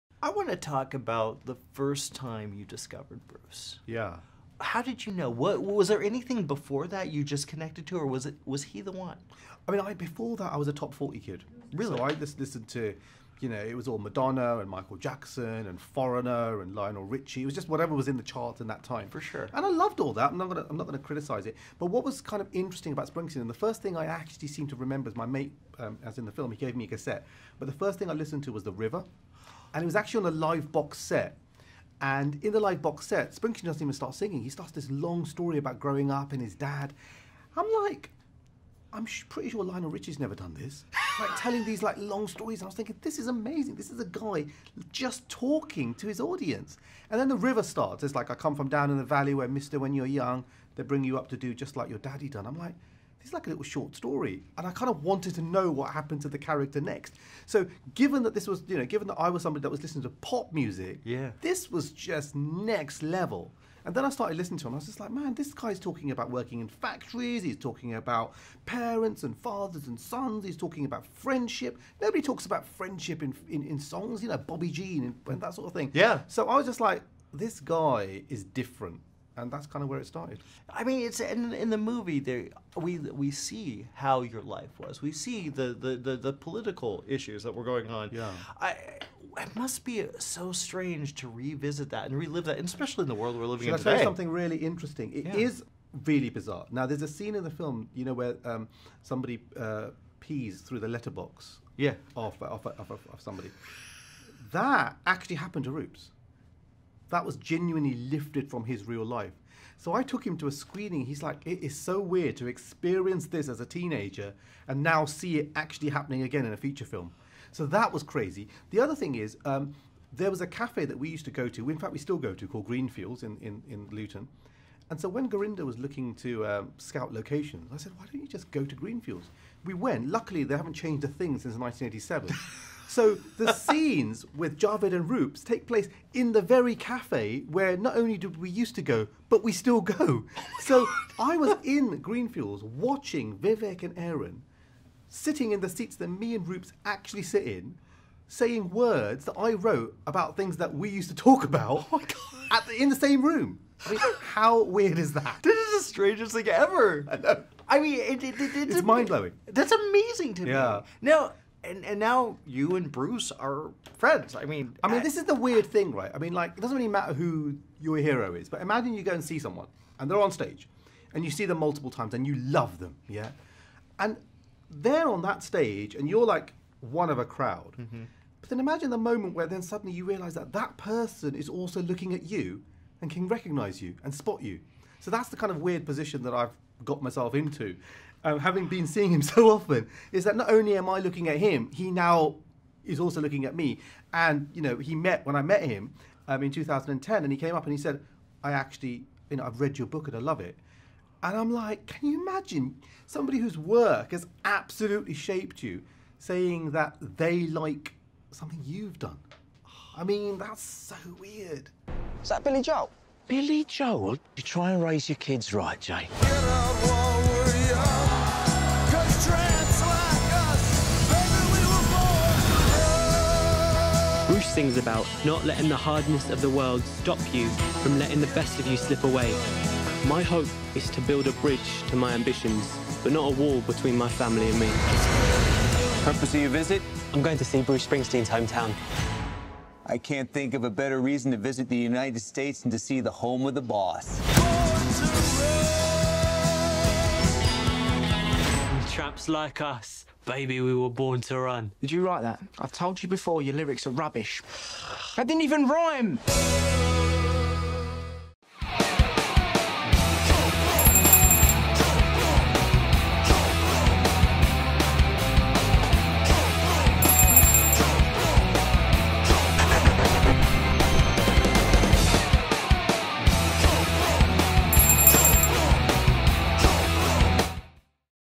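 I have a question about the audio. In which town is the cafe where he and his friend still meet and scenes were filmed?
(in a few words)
Luton.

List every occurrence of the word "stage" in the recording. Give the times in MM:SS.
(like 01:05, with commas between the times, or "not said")
02:50, 02:55.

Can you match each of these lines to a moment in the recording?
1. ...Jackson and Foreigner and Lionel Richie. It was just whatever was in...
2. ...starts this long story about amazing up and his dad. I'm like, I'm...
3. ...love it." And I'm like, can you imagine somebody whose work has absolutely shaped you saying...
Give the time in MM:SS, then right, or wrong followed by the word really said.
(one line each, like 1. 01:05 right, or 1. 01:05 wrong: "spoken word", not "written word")
1. 00:14 right
2. 00:34 wrong: "growing", not "amazing"
3. 03:20 right.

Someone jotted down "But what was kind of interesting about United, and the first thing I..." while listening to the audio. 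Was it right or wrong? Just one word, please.
wrong.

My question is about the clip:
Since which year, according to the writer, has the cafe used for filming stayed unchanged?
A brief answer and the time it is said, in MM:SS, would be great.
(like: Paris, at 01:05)
1987, at 02:11.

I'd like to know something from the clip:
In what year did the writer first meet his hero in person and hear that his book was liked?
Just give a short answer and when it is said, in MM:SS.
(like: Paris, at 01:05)
2010, at 03:16.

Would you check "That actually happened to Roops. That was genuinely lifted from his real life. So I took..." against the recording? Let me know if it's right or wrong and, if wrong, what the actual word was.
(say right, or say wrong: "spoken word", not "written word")
right.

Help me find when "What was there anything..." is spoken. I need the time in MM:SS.
00:05.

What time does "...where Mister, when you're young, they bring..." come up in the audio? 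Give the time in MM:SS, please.
00:49.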